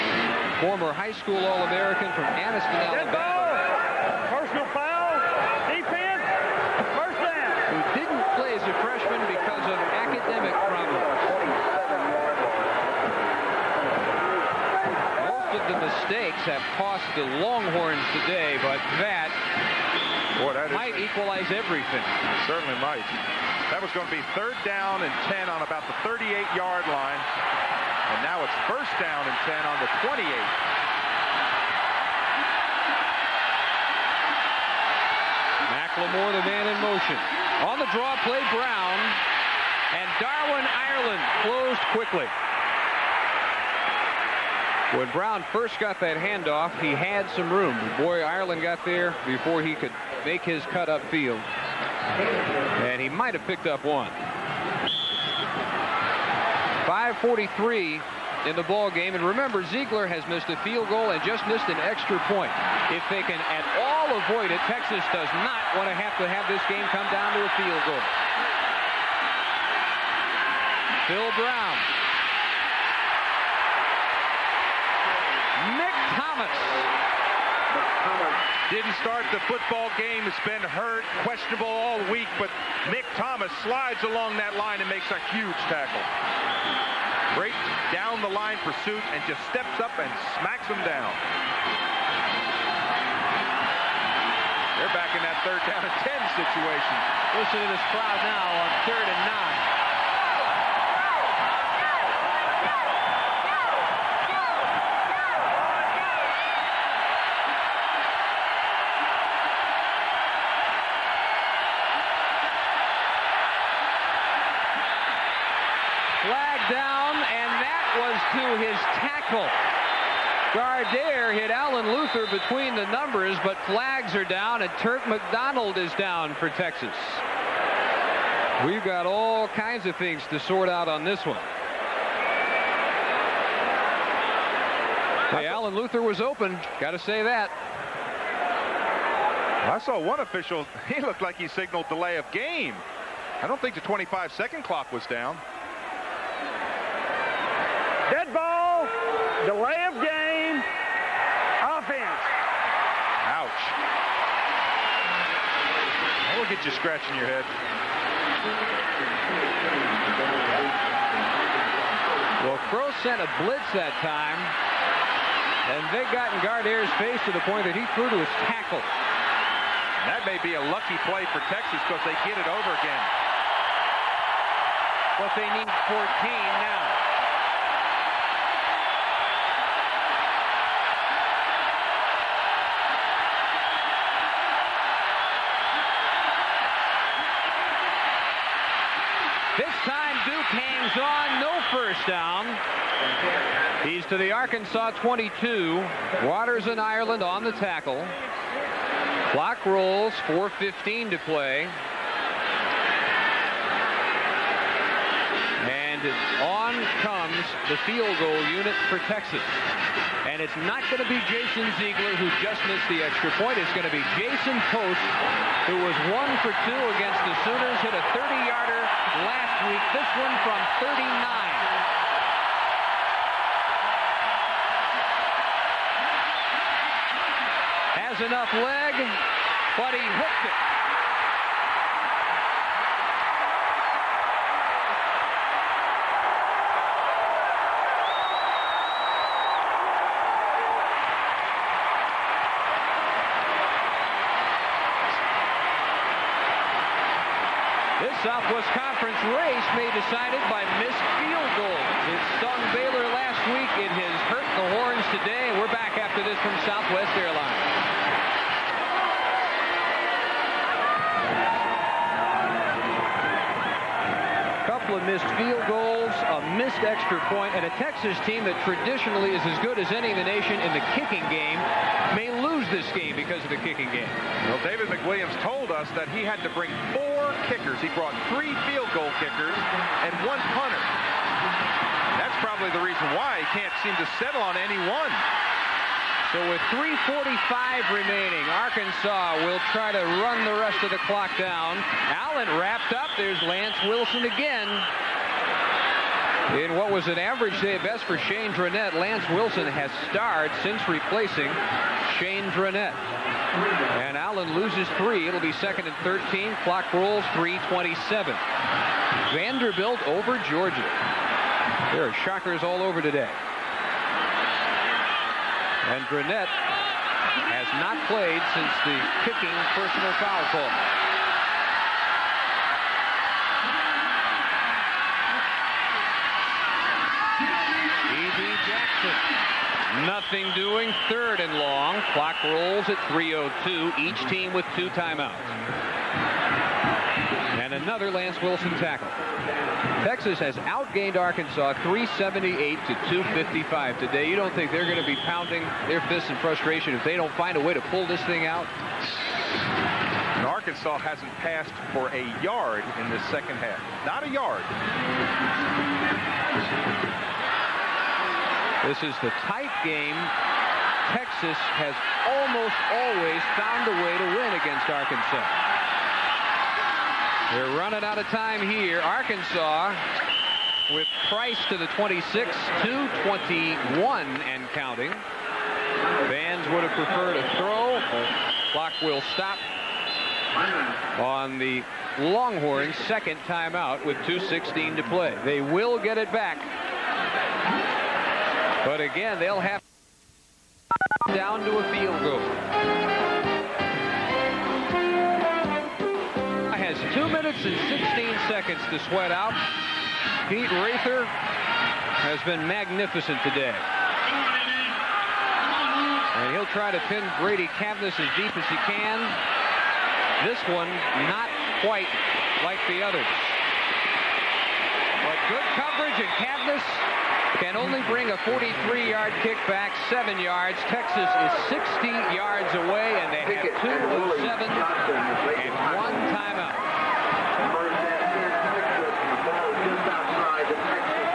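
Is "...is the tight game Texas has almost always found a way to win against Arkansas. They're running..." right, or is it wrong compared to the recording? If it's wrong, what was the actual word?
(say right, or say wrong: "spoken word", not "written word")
right.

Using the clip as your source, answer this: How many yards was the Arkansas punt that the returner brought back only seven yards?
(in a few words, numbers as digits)
43.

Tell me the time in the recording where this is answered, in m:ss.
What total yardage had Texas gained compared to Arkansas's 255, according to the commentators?
5:41.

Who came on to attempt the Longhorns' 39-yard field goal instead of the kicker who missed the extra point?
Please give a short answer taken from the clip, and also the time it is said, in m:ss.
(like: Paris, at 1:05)
Jason Post, at 3:34.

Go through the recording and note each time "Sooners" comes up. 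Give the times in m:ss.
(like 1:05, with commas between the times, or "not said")
3:37.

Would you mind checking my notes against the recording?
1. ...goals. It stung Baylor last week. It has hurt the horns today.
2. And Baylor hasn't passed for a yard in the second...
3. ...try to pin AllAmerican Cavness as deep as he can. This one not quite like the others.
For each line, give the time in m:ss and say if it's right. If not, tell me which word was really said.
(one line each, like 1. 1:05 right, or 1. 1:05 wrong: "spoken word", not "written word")
1. 4:11 right
2. 5:50 wrong: "Arkansas", not "Baylor"
3. 6:46 wrong: "Grady", not "AllAmerican".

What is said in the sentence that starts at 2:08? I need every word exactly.
We've got all kinds of things to sort out on this one.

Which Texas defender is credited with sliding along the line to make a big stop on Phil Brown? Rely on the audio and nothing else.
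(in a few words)
Mick Thomas.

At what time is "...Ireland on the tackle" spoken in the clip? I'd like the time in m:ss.
3:16.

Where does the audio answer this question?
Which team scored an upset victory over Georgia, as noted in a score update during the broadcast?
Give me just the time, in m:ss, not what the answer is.
5:09.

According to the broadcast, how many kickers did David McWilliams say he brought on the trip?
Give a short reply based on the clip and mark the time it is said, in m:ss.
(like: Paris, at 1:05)
4, at 4:36.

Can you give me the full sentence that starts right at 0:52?
And he might have picked up one.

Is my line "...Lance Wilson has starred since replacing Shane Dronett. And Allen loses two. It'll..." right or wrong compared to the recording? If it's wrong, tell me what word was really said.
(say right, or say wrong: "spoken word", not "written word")
wrong: "three", not "two".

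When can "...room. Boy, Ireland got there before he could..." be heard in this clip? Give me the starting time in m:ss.
0:47.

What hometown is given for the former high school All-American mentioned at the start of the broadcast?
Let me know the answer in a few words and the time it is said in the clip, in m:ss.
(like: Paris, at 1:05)
Anniston, Alabama, at 0:02.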